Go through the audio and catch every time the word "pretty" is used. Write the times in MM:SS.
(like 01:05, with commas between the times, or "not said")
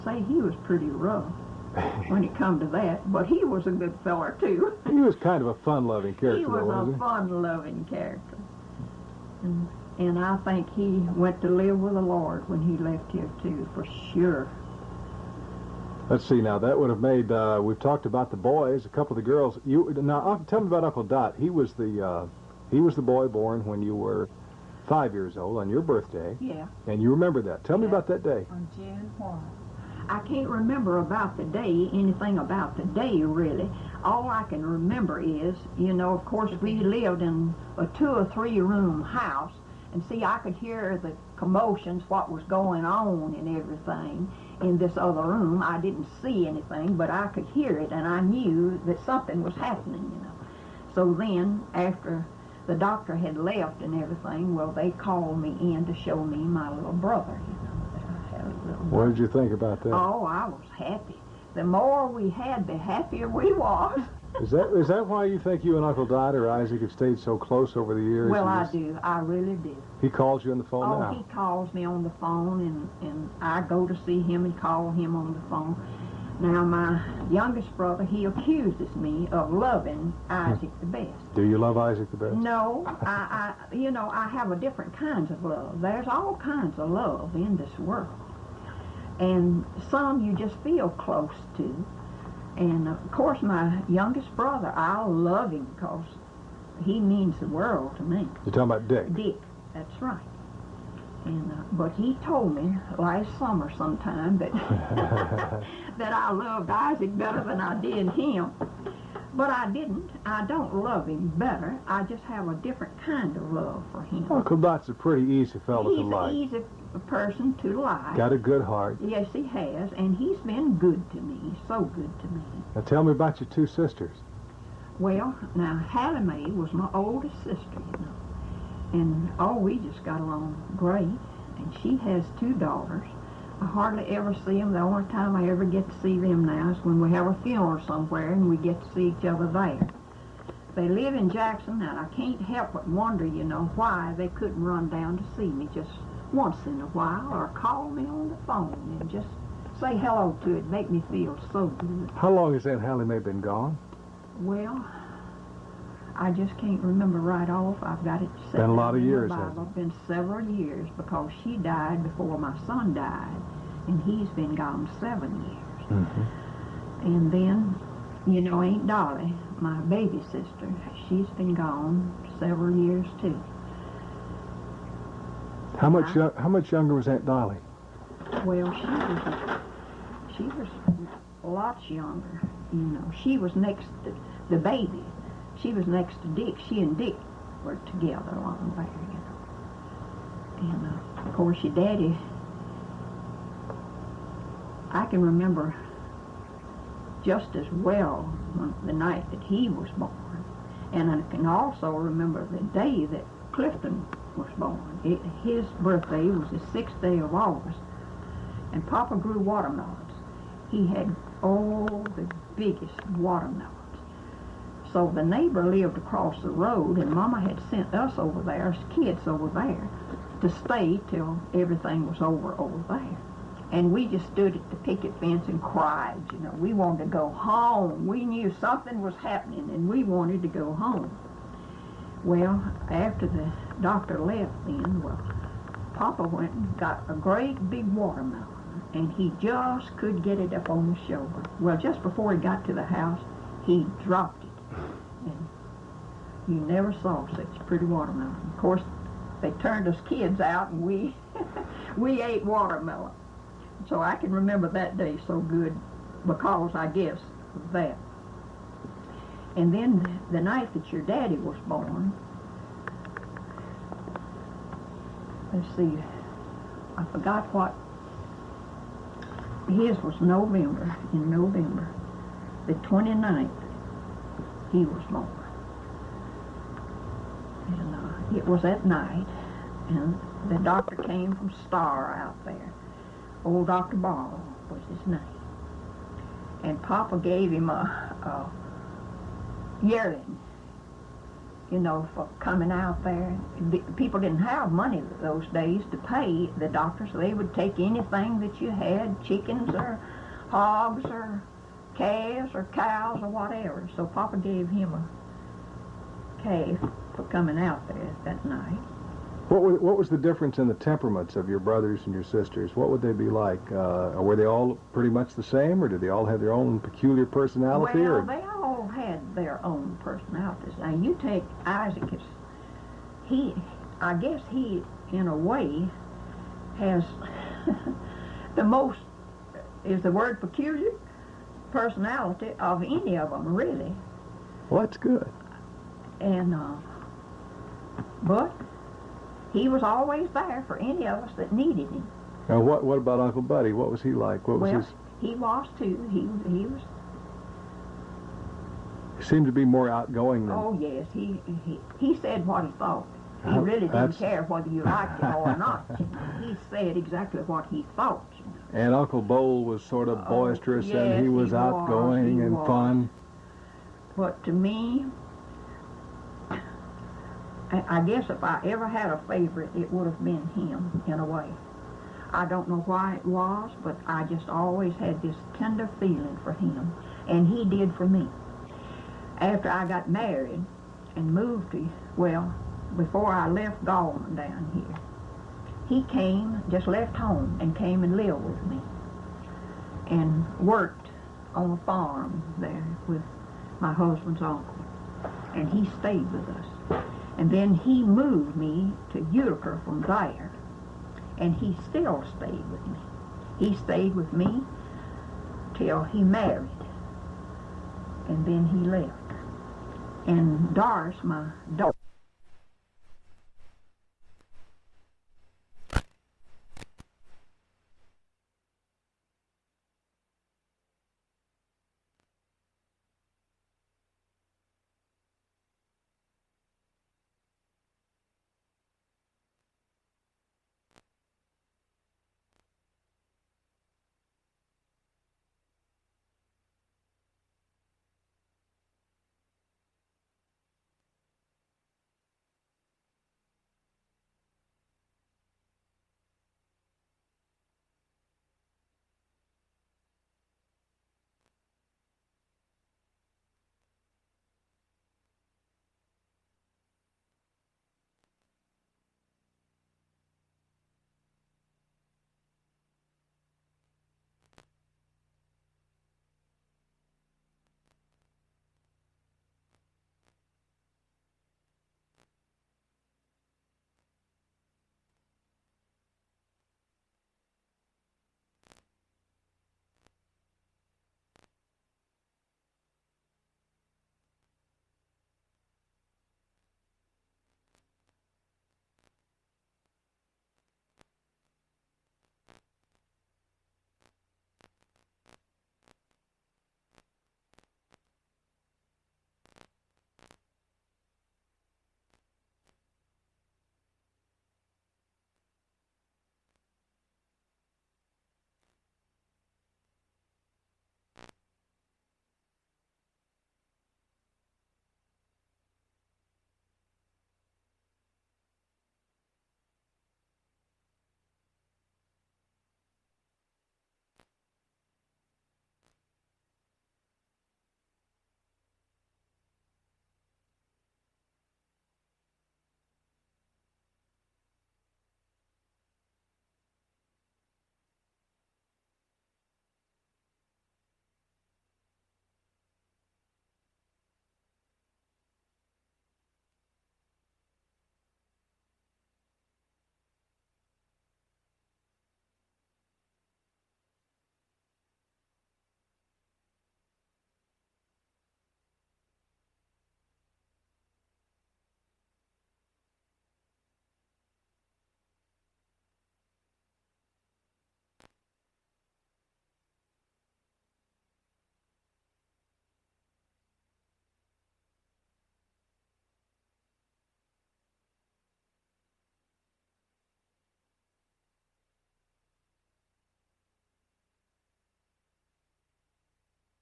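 00:00, 01:54, 04:07, 05:14.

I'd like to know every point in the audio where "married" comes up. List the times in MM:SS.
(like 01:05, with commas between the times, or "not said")
06:20, 06:46.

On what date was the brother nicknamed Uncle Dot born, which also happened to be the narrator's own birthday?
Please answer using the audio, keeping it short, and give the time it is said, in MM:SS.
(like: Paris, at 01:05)
June 1, at 00:28.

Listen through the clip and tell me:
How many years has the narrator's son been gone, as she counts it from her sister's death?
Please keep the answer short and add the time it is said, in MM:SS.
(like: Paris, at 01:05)
7, at 02:44.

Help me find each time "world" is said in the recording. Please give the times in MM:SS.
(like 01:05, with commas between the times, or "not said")
01:27, 01:37.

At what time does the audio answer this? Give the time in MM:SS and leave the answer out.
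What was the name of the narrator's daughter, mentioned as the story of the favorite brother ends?
06:50.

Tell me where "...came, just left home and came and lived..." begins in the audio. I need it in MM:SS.
06:26.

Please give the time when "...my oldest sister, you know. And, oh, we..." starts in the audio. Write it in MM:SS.
02:06.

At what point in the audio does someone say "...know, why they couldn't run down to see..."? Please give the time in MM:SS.
02:23.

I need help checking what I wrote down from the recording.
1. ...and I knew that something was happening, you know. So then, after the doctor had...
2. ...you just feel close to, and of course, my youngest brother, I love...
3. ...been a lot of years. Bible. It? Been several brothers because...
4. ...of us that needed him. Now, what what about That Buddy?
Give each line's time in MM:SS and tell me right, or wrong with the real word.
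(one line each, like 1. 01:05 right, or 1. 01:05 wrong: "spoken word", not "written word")
1. 00:47 right
2. 01:30 right
3. 02:38 wrong: "years", not "brothers"
4. 05:41 wrong: "Uncle", not "That".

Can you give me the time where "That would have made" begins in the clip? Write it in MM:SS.
00:16.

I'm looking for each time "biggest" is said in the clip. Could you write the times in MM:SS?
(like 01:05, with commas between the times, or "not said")
03:32.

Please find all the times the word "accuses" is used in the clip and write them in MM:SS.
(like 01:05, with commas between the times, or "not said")
01:18.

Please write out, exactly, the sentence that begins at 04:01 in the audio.
Well, just before he got to the house, he dropped it.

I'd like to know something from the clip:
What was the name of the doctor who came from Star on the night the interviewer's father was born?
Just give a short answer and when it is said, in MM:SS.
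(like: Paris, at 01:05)
Dr. Ball, at 04:43.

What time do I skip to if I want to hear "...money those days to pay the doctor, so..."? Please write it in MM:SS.
04:54.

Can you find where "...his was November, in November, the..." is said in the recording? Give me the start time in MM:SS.
04:29.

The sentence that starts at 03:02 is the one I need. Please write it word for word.
You know, she was next to the baby.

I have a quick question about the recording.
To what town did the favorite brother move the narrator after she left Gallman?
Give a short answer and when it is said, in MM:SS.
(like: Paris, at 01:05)
Utica, at 06:39.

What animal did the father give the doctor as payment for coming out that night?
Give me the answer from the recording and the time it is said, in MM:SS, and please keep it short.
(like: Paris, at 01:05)
A yearling, at 04:49.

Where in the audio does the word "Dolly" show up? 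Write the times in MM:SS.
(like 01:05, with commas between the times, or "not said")
02:48, 02:57.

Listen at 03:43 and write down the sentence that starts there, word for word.
And we just stood at the picket fence and cried, you know.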